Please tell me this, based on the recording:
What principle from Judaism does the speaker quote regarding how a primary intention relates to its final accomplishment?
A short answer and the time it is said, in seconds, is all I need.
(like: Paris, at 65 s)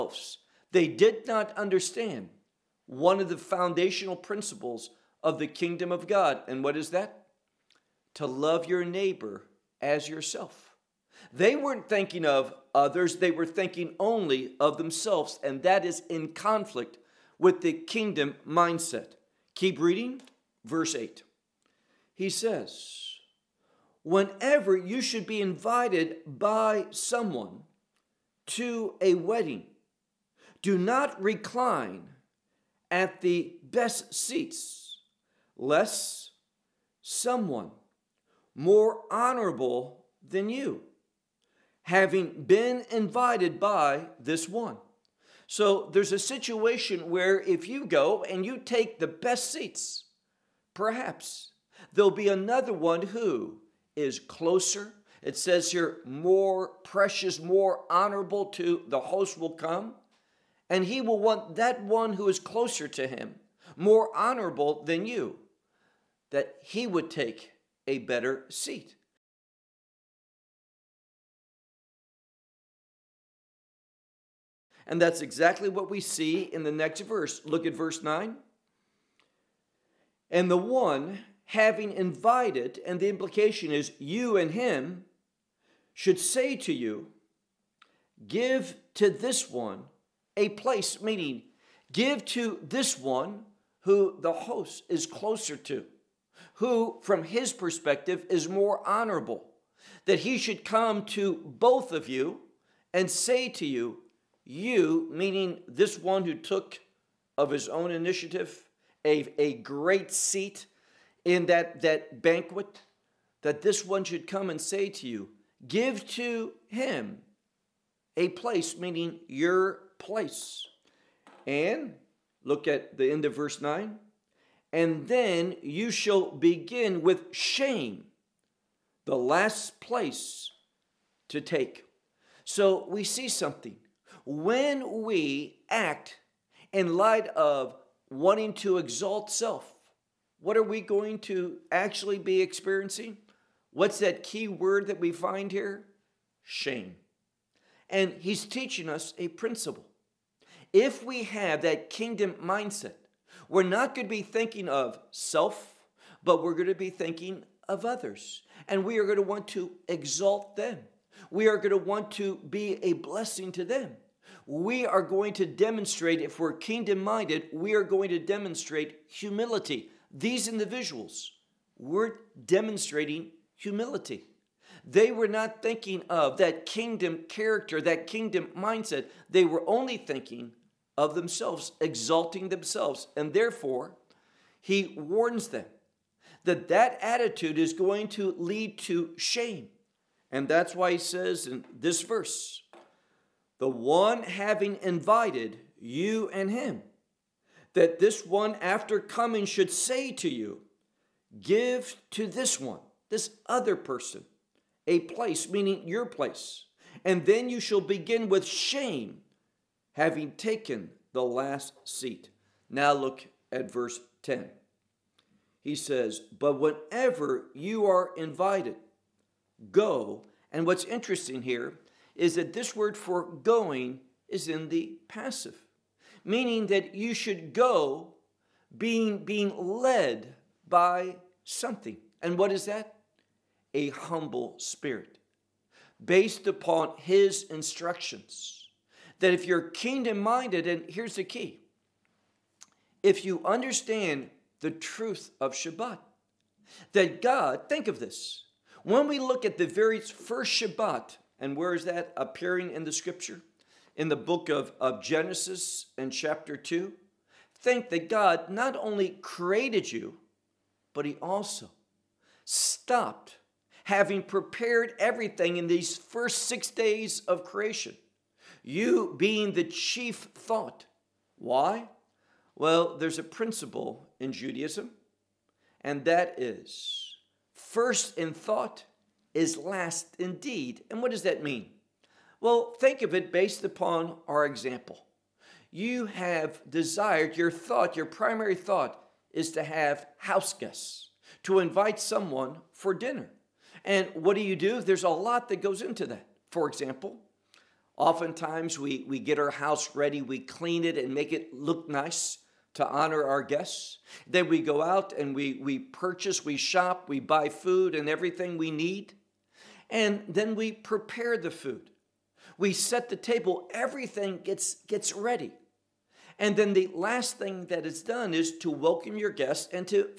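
First in thought is last in deed, at 277 s.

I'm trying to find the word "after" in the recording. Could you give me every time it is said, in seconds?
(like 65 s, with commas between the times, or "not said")
198 s.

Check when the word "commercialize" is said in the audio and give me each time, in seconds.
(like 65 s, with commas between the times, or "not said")
not said.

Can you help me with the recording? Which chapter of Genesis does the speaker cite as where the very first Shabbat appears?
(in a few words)
Chapter 2.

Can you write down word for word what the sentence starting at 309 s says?
And then we prepare the food we set the table, everything gets, gets ready.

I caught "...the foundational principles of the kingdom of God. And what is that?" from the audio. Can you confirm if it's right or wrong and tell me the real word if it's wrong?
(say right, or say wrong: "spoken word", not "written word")
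right.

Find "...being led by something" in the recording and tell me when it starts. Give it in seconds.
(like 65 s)
229 s.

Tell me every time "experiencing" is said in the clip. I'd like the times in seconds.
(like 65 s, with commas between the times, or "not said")
142 s.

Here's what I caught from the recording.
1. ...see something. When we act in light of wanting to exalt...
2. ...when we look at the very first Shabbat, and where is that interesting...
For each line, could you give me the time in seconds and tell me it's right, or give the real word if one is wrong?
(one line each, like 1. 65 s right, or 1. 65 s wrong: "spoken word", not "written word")
1. 133 s right
2. 248 s wrong: "appearing", not "interesting".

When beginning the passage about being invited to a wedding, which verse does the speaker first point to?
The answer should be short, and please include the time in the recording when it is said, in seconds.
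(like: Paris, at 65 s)
8, at 20 s.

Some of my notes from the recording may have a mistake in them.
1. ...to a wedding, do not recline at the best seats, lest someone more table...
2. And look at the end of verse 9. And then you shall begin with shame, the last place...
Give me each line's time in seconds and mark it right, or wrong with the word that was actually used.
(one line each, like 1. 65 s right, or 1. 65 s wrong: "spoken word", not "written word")
1. 28 s wrong: "honorable", not "table"
2. 121 s right.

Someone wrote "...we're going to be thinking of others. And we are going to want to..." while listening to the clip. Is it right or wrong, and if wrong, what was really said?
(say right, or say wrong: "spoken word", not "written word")
right.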